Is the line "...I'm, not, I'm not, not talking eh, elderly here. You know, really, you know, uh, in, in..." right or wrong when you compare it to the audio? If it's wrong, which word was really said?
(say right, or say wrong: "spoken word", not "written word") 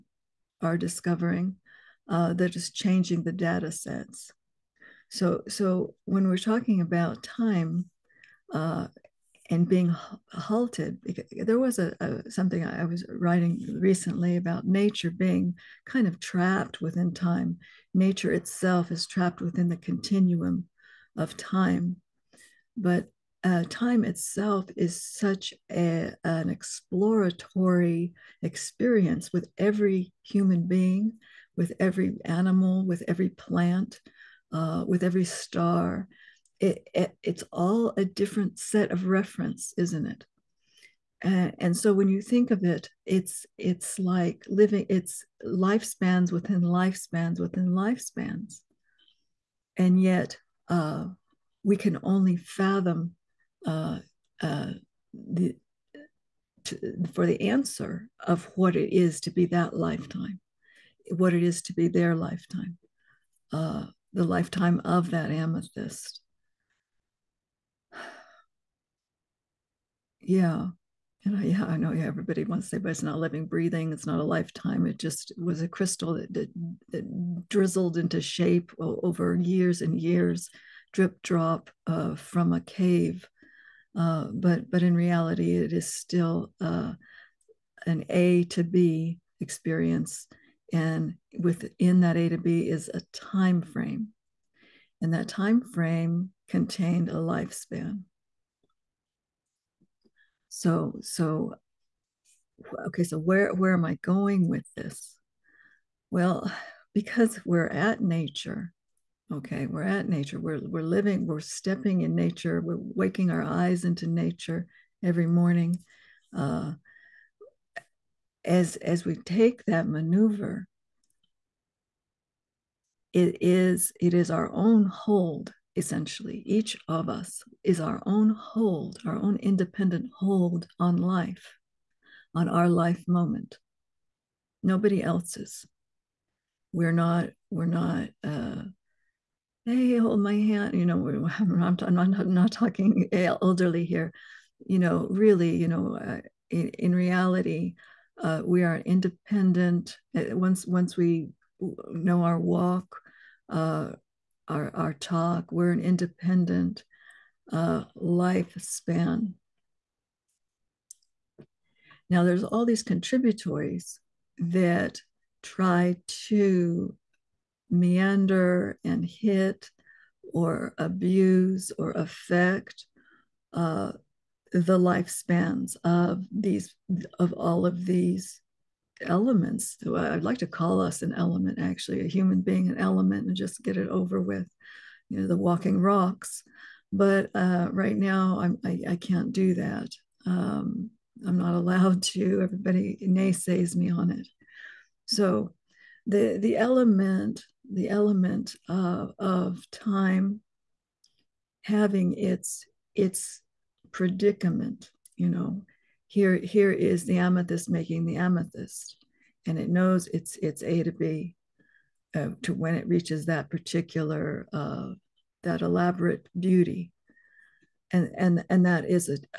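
right.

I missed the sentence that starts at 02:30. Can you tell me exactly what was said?
Eh, once, once we know our walk, uh, our, our talk.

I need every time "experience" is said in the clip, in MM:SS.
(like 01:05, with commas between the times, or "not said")
00:28, 01:29.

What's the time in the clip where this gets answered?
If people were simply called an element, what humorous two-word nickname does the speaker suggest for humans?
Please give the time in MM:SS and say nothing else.
03:05.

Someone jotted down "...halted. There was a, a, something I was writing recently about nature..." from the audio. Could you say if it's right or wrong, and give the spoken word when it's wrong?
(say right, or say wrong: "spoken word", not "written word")
right.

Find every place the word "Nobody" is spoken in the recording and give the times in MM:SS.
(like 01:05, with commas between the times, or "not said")
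02:14.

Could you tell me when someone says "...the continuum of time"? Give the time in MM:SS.
00:19.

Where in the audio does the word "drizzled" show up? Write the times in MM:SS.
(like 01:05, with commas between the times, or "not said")
01:17.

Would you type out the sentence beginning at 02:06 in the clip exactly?
Each of us is our own hold, our own independent hold on life, on our life moment.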